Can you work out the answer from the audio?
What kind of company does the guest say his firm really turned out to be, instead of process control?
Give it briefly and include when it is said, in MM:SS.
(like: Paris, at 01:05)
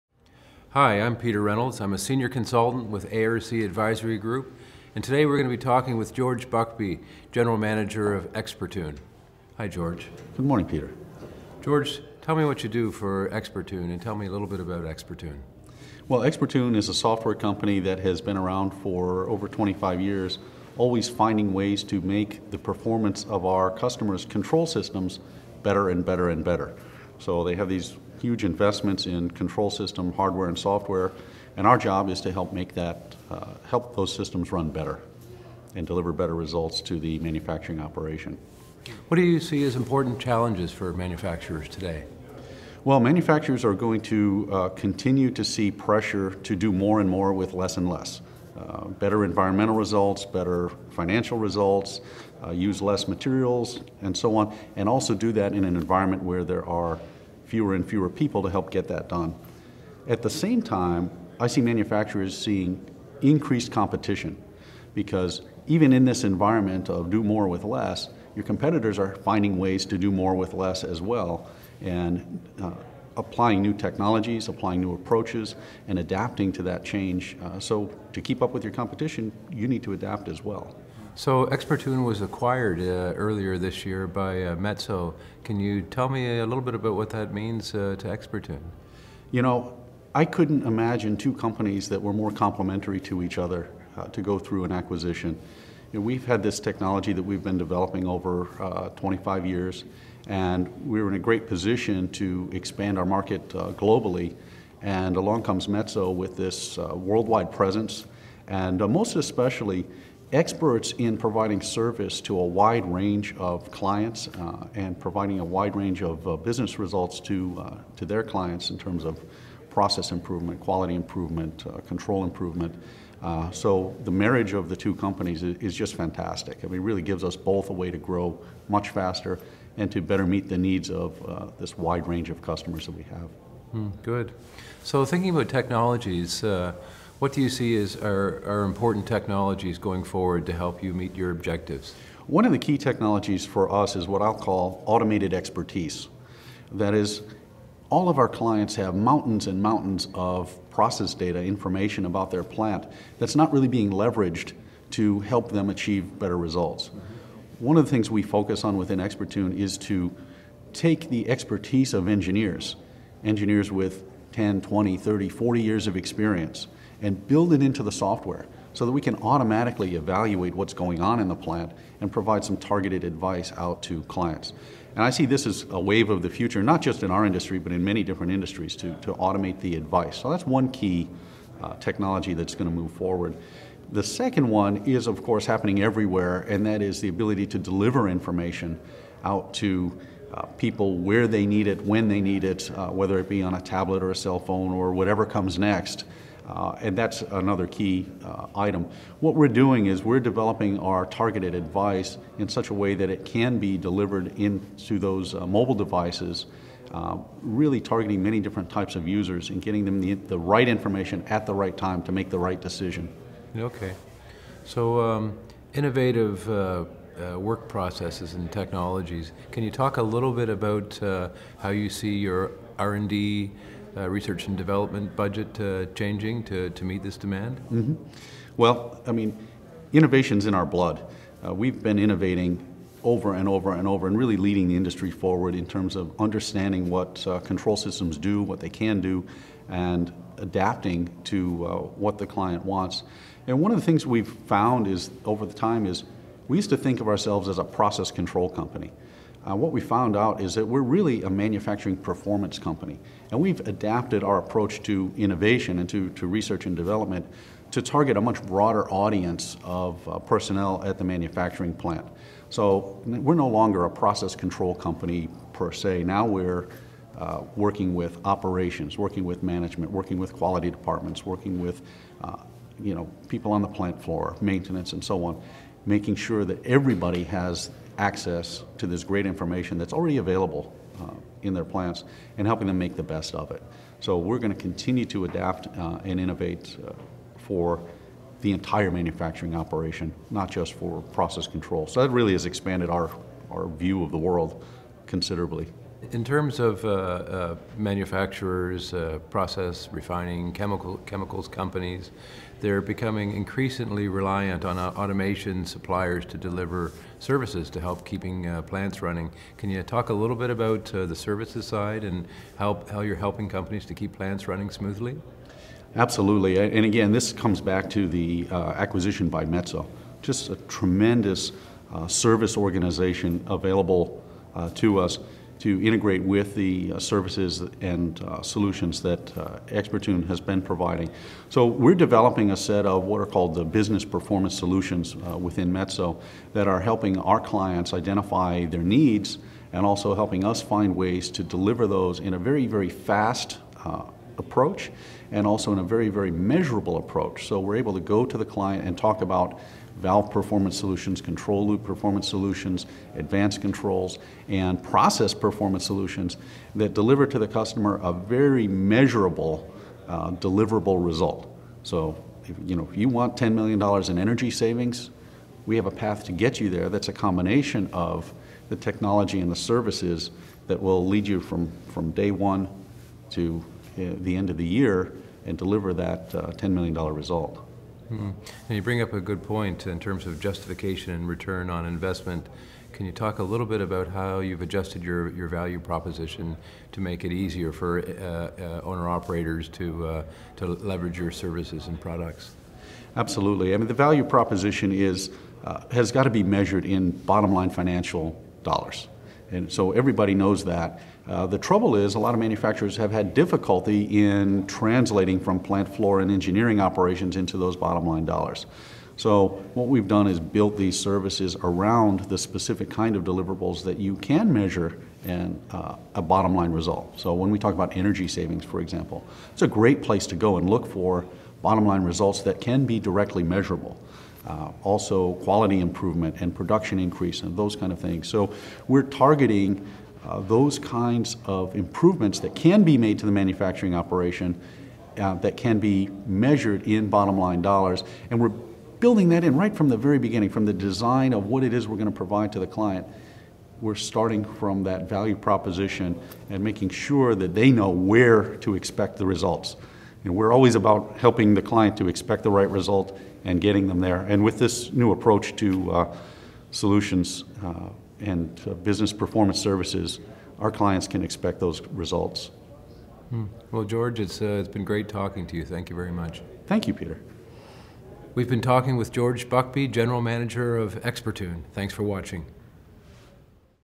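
manufacturing performance company, at 04:11.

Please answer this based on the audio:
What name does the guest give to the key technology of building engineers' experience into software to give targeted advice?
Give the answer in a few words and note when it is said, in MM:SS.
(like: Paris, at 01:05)
automated expertise, at 02:24.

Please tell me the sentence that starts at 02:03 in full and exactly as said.
Uh, so the marriage of the two companies is, is just fantastic.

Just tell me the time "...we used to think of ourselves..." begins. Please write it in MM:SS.
04:06.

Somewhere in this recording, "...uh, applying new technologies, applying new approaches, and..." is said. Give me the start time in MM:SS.
01:12.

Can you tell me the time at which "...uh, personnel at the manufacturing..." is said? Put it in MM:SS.
04:20.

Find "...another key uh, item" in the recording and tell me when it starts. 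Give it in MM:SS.
03:17.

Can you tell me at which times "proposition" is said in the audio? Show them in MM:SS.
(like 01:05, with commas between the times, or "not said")
06:25, 06:34, 07:25.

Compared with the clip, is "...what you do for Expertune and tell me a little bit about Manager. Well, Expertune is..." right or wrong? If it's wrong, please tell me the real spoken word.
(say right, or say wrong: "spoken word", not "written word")
wrong: "Expertune", not "Manager".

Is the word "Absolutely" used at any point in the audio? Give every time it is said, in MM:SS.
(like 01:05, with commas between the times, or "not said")
05:15, 06:33.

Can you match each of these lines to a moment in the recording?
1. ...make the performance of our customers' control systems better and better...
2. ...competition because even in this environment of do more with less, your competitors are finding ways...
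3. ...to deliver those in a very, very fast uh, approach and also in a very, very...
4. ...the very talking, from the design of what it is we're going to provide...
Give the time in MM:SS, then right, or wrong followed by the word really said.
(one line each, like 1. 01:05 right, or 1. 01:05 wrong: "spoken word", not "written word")
1. 00:21 right
2. 01:03 right
3. 05:41 right
4. 07:19 wrong: "beginning", not "talking".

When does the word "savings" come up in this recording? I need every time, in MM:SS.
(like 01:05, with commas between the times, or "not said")
06:04, 06:58.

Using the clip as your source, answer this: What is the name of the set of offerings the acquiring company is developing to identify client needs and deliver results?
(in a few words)
business performance solutions.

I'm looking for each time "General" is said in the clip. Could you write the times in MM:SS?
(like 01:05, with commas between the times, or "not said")
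00:07, 07:49.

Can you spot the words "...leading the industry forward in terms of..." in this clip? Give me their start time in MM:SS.
03:54.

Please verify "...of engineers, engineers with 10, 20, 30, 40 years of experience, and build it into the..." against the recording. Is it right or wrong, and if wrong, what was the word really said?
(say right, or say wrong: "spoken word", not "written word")
right.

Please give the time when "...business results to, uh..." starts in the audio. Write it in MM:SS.
01:56.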